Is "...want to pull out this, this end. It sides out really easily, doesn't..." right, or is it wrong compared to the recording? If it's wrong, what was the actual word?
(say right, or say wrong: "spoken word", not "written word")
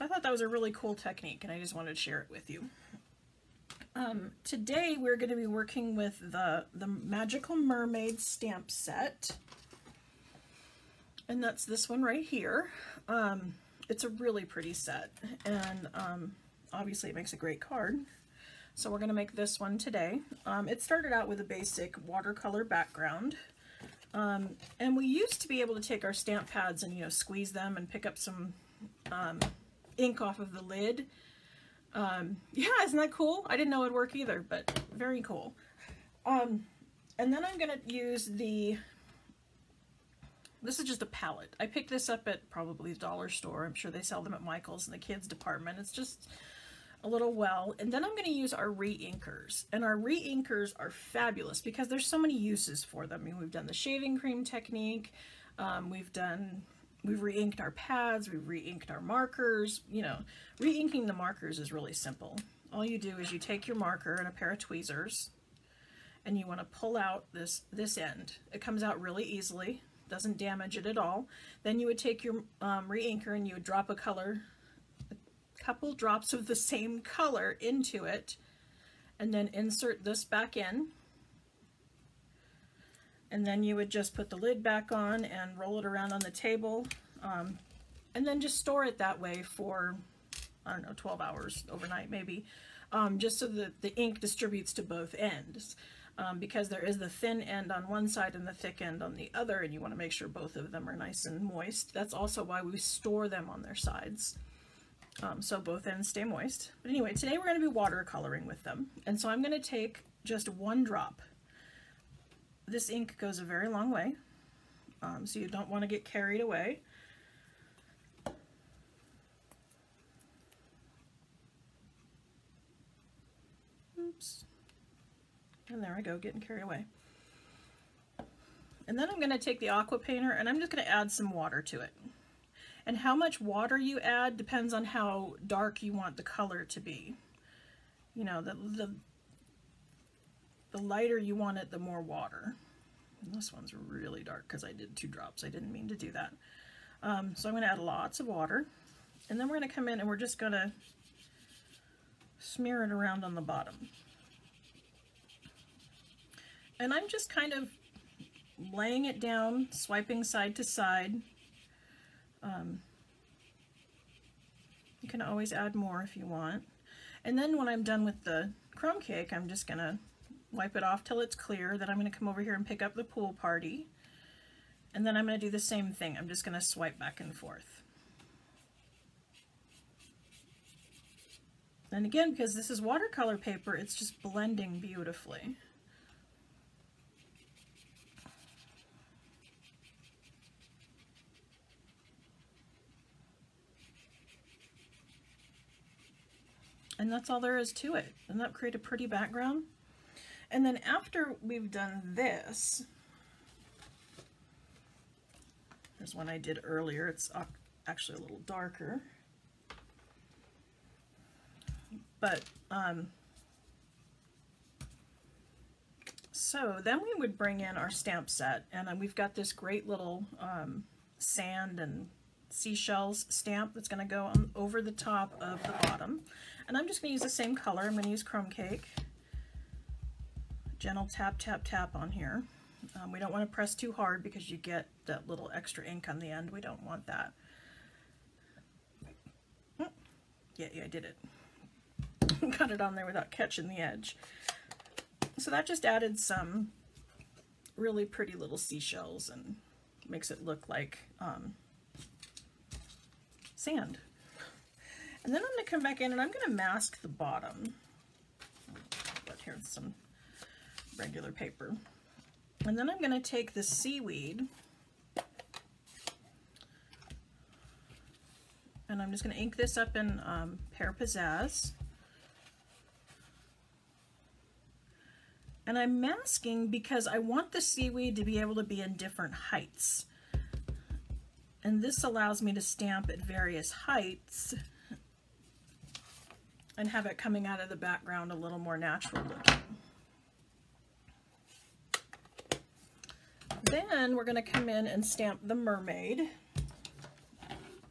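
wrong: "comes", not "sides".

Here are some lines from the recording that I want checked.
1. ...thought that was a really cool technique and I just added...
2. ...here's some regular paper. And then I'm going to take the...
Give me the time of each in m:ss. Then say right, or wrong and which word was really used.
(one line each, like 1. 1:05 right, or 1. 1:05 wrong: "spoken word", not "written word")
1. 0:00 wrong: "wanted", not "added"
2. 4:19 right.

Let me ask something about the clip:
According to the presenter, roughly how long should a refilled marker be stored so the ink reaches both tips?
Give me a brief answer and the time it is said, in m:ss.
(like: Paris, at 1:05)
12 hours, at 1:30.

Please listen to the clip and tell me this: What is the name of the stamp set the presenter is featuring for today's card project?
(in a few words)
Magical Mermaid.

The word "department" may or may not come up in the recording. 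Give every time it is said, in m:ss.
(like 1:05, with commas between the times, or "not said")
0:45.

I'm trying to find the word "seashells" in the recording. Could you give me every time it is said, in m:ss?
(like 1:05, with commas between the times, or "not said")
3:42, 4:08.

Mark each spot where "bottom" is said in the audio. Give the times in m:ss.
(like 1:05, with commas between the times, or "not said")
2:33, 3:45, 4:17.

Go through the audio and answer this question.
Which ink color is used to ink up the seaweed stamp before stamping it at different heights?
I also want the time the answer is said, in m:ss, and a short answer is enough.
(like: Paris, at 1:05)
Pear Pizzazz, at 4:30.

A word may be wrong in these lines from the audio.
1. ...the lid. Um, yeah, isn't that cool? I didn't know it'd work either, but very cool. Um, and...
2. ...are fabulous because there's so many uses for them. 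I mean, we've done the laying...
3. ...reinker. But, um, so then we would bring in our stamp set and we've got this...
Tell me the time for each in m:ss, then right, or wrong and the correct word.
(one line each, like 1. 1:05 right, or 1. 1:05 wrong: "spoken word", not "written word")
1. 0:30 right
2. 0:50 wrong: "shaving", not "laying"
3. 3:28 wrong: "darker", not "reinker".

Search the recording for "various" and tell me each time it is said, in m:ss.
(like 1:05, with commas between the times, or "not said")
4:43.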